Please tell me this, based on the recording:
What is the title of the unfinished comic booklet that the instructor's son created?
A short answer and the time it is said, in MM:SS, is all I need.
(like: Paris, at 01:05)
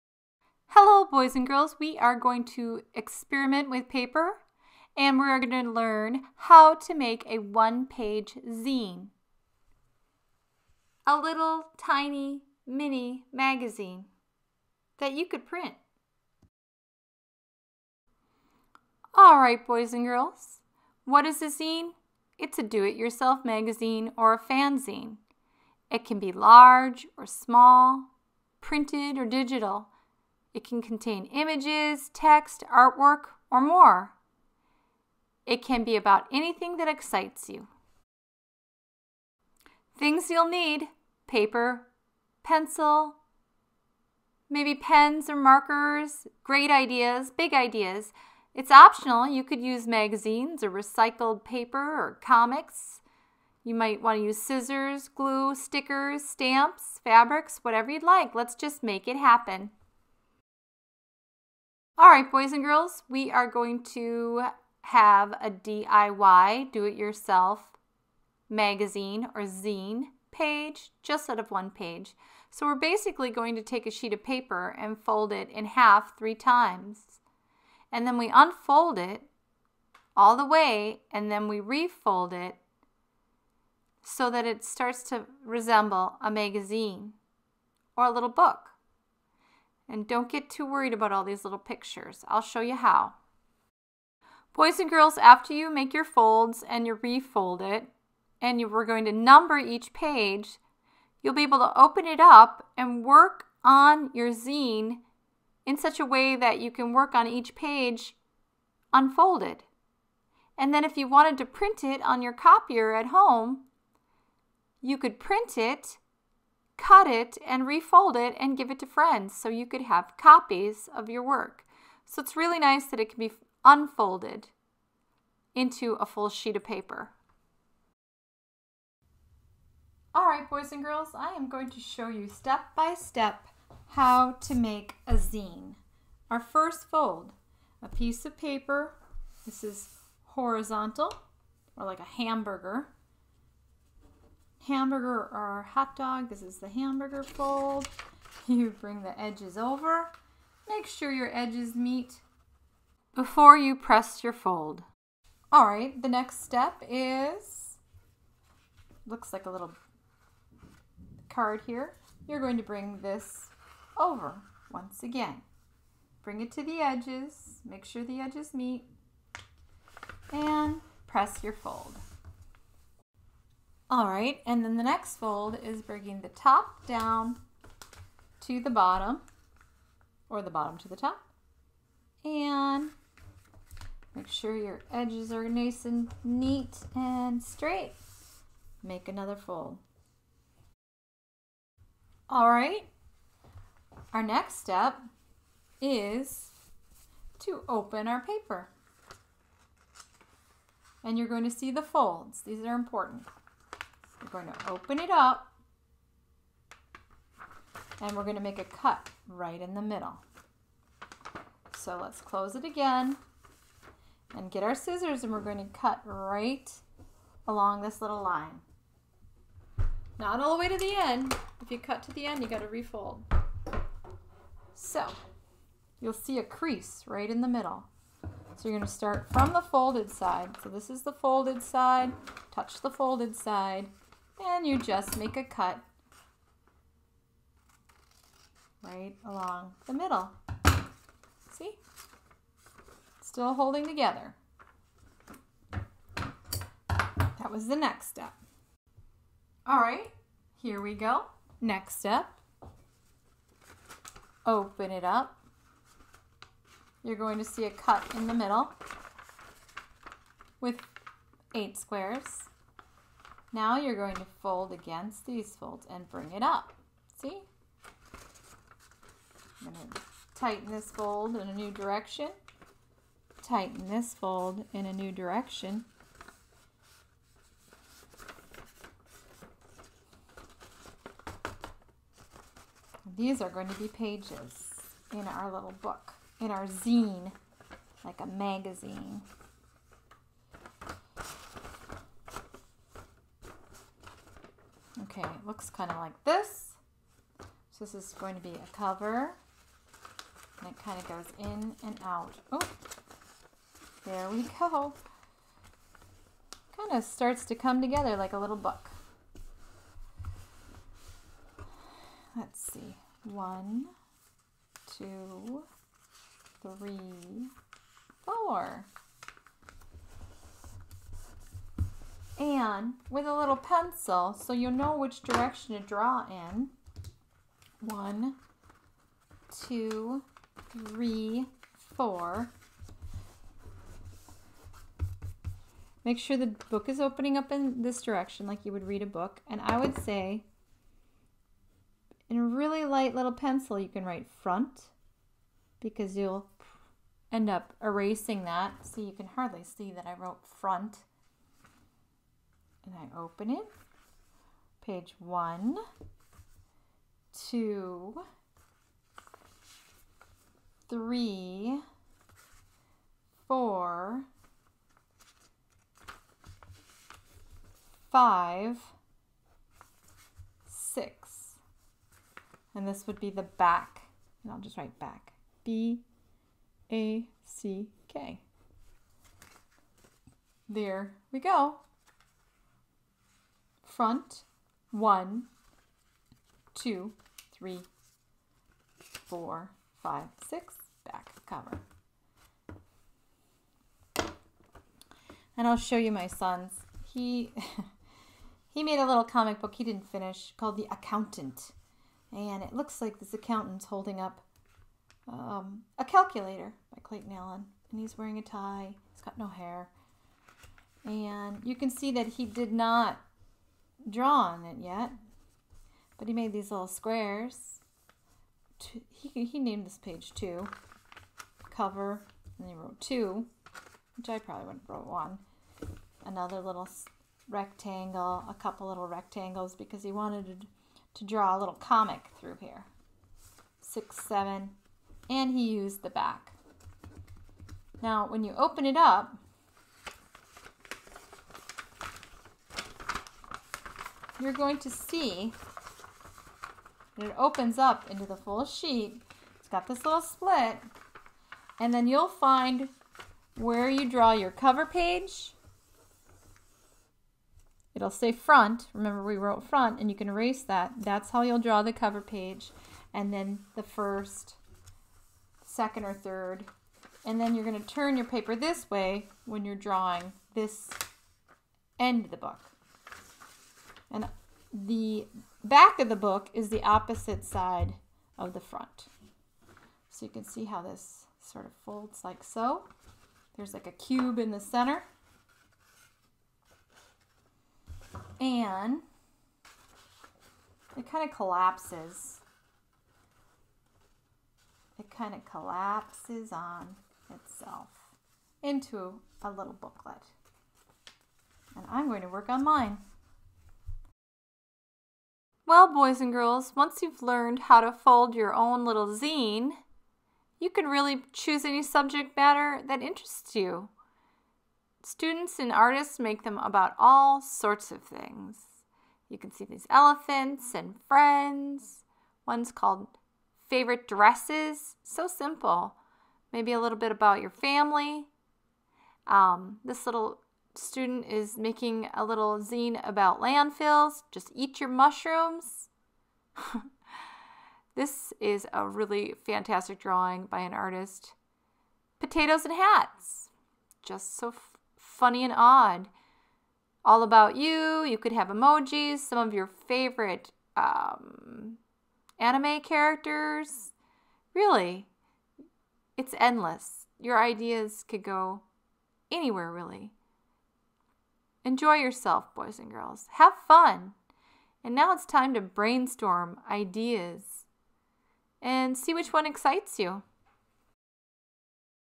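The Accountant, at 06:40.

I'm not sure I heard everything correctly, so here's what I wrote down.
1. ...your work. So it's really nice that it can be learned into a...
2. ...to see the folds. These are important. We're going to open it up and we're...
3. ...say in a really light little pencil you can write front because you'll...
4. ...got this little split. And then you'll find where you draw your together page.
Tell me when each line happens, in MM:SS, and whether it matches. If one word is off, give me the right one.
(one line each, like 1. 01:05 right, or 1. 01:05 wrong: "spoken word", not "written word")
1. 02:01 wrong: "unfolded", not "learned"
2. 03:21 right
3. 05:39 right
4. 07:29 wrong: "cover", not "together".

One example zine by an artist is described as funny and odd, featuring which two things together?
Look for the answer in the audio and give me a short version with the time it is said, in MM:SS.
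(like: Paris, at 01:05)
potatoes and hats, at 09:02.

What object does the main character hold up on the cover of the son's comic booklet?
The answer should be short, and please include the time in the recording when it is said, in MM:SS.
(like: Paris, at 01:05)
a calculator, at 06:45.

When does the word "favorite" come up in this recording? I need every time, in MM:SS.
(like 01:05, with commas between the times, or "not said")
08:43, 09:09.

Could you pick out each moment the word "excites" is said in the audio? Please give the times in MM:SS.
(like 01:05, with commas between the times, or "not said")
00:36, 09:29.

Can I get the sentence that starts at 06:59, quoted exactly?
He, he named this page two, cover, and he wrote two, which I probably would not wrote one.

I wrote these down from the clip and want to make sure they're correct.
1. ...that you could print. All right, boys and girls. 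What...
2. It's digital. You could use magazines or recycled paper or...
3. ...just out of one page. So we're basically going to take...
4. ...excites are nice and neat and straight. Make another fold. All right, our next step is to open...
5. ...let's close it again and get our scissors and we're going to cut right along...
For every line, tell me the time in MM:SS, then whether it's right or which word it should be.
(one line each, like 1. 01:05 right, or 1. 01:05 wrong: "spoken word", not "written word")
1. 00:14 right
2. 00:48 wrong: "optional", not "digital"
3. 01:11 right
4. 03:04 wrong: "edges", not "excites"
5. 03:31 right.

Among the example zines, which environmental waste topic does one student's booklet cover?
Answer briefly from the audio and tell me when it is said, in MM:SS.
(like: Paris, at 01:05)
landfills, at 08:53.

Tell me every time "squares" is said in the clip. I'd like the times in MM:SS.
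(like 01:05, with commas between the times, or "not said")
04:21, 06:56.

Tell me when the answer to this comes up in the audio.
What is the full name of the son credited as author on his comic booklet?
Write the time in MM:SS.
06:47.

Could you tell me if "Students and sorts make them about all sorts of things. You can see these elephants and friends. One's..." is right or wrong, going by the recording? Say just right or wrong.
wrong.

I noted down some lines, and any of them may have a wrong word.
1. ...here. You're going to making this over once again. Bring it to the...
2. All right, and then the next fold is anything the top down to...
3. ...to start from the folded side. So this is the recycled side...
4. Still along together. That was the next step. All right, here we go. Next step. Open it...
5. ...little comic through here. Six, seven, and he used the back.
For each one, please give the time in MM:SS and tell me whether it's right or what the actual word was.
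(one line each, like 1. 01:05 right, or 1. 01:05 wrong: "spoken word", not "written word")
1. 02:41 wrong: "bring", not "making"
2. 02:53 wrong: "bringing", not "anything"
3. 03:48 wrong: "folded", not "recycled"
4. 04:03 wrong: "holding", not "along"
5. 07:11 right.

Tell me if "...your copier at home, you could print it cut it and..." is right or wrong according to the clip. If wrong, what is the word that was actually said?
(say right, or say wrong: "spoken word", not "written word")
right.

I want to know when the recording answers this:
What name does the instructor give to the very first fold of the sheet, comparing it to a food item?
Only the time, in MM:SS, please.
02:26.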